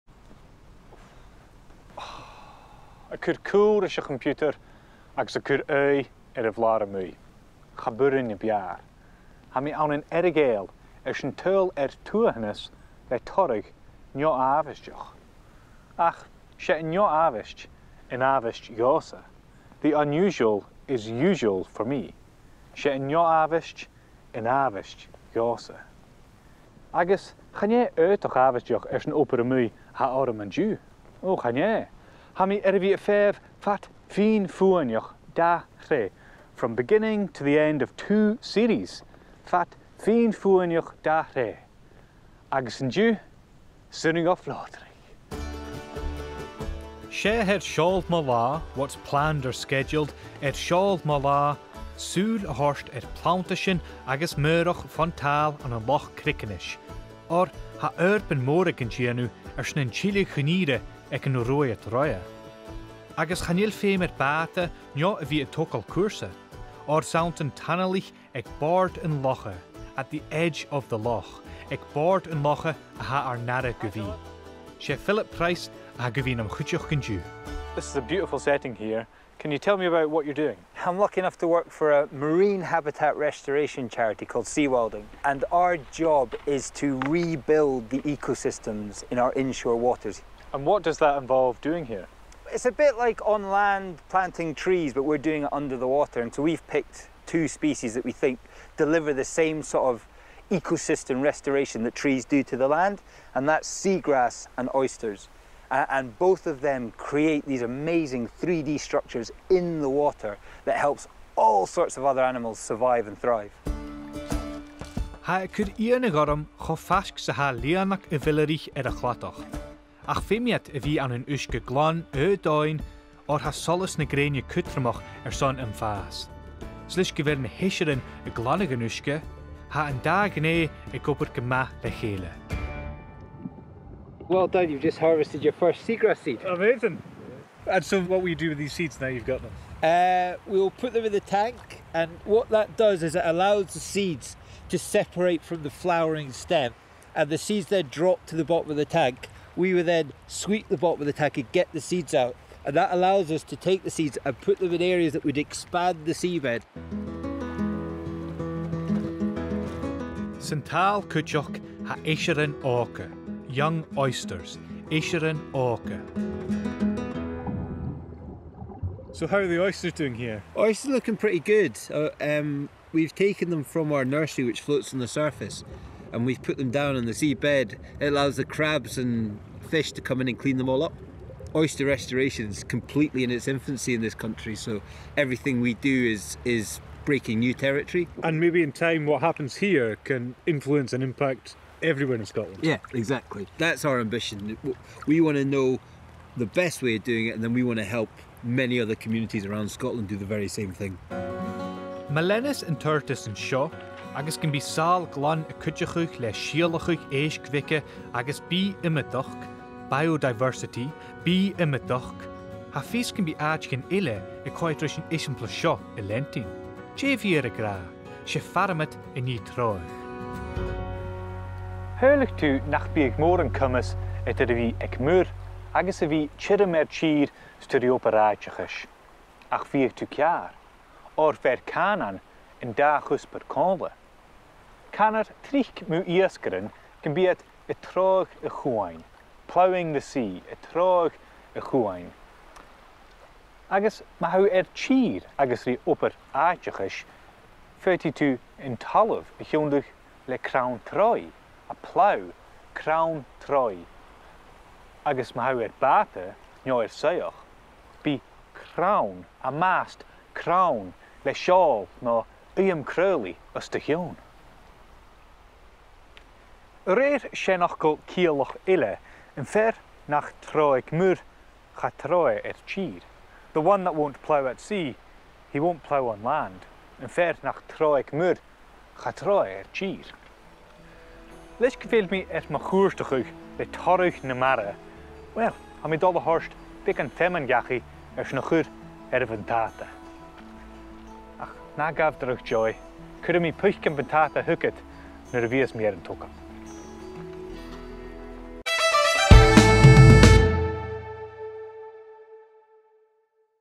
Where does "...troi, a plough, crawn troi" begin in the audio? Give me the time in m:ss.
4:10.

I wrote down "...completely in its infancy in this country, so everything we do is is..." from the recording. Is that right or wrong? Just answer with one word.
right.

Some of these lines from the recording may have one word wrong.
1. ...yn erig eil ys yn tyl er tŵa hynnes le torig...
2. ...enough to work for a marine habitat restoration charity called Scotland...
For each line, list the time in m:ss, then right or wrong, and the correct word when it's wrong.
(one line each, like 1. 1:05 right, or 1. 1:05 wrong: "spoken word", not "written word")
1. 0:09 right
2. 1:21 wrong: "Sea", not "Scotland".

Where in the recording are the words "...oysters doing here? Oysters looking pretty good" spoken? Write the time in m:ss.
2:49.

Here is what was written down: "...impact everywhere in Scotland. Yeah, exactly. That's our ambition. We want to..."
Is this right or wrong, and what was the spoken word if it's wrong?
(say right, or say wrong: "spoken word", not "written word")
right.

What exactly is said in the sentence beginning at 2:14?
Well done, you've just harvested your first seagrass seed.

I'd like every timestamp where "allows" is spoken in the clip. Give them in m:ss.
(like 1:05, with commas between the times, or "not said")
2:23, 2:32, 2:58.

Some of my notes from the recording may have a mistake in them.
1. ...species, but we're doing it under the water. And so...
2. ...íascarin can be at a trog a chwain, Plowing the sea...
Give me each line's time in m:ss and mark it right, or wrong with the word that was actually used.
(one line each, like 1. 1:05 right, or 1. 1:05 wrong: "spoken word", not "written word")
1. 1:34 wrong: "trees", not "species"
2. 3:56 right.